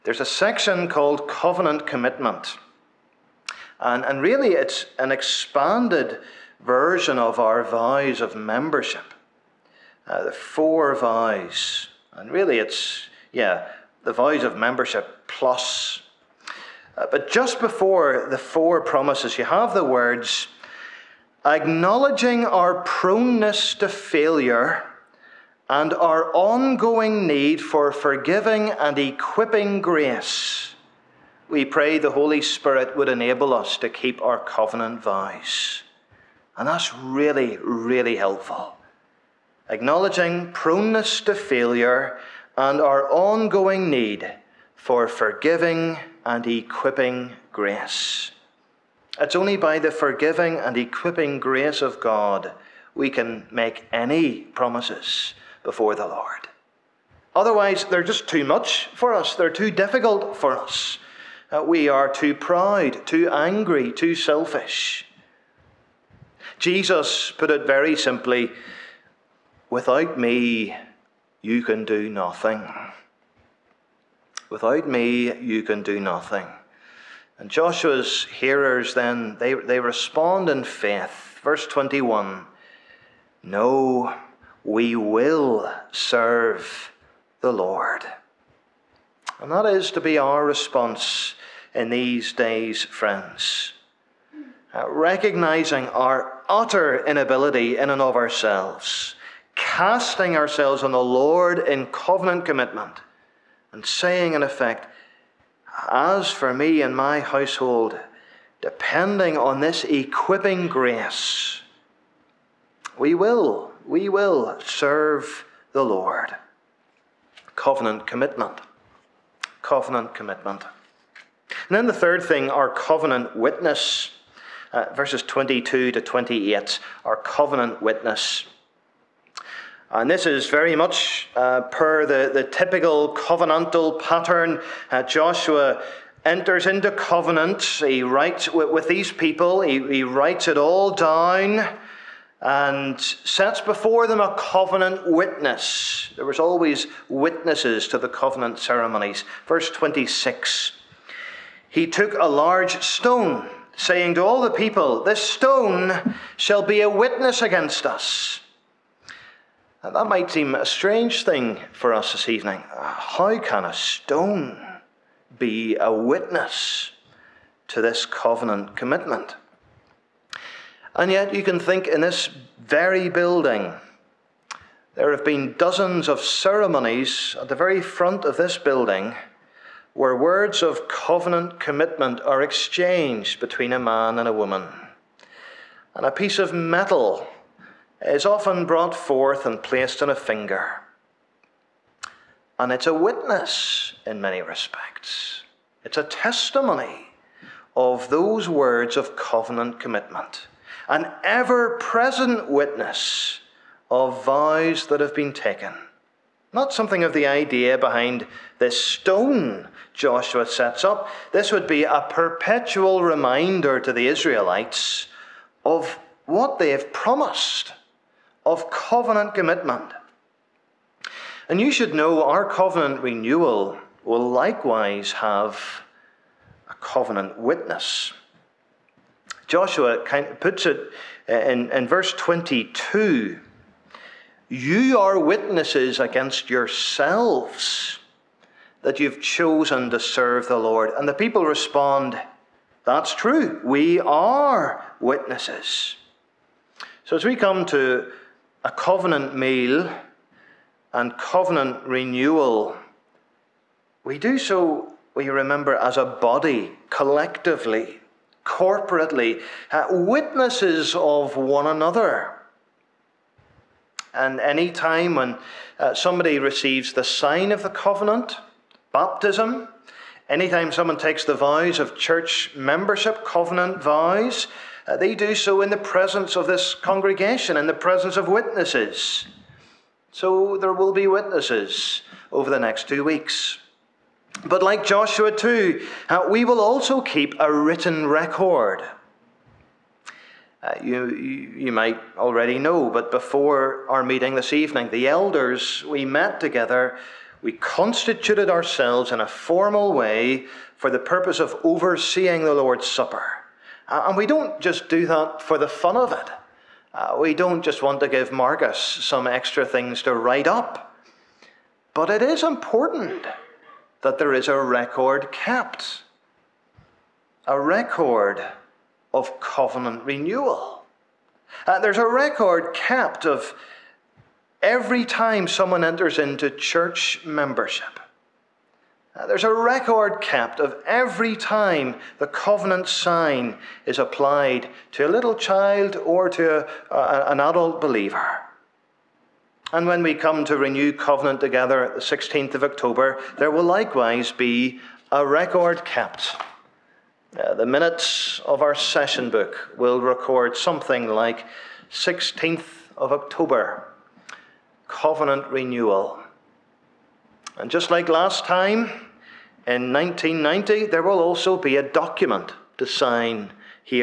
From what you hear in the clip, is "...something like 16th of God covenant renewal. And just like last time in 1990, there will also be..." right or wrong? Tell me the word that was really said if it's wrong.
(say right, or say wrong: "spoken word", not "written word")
wrong: "October", not "God".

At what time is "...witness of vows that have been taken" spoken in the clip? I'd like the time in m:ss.
3:22.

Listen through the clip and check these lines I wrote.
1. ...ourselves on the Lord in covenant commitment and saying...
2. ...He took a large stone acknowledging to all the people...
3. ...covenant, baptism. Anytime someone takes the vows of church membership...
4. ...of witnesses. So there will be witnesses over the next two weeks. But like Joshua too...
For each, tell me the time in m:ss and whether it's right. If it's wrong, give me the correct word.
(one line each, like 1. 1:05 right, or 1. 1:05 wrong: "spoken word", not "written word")
1. 1:40 right
2. 2:31 wrong: "saying", not "acknowledging"
3. 4:27 right
4. 4:38 right.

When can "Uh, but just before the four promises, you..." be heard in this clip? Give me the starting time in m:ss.
0:16.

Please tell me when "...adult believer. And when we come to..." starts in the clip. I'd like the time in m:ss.
5:37.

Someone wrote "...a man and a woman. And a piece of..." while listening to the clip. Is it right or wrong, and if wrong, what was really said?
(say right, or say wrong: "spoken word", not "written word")
right.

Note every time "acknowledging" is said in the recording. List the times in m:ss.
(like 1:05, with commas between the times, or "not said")
0:21, 0:39.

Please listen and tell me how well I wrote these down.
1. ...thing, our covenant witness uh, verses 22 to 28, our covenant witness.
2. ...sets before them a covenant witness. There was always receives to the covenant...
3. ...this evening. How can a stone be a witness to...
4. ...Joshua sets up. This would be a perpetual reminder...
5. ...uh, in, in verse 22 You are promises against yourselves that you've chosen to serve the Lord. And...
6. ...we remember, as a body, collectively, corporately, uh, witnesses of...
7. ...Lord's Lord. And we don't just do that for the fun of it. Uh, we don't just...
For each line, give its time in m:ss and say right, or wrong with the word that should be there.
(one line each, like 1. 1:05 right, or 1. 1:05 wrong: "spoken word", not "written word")
1. 2:02 right
2. 2:23 wrong: "witnesses", not "receives"
3. 2:42 right
4. 3:29 right
5. 3:51 wrong: "witnesses", not "promises"
6. 4:15 right
7. 5:02 wrong: "Supper", not "Lord".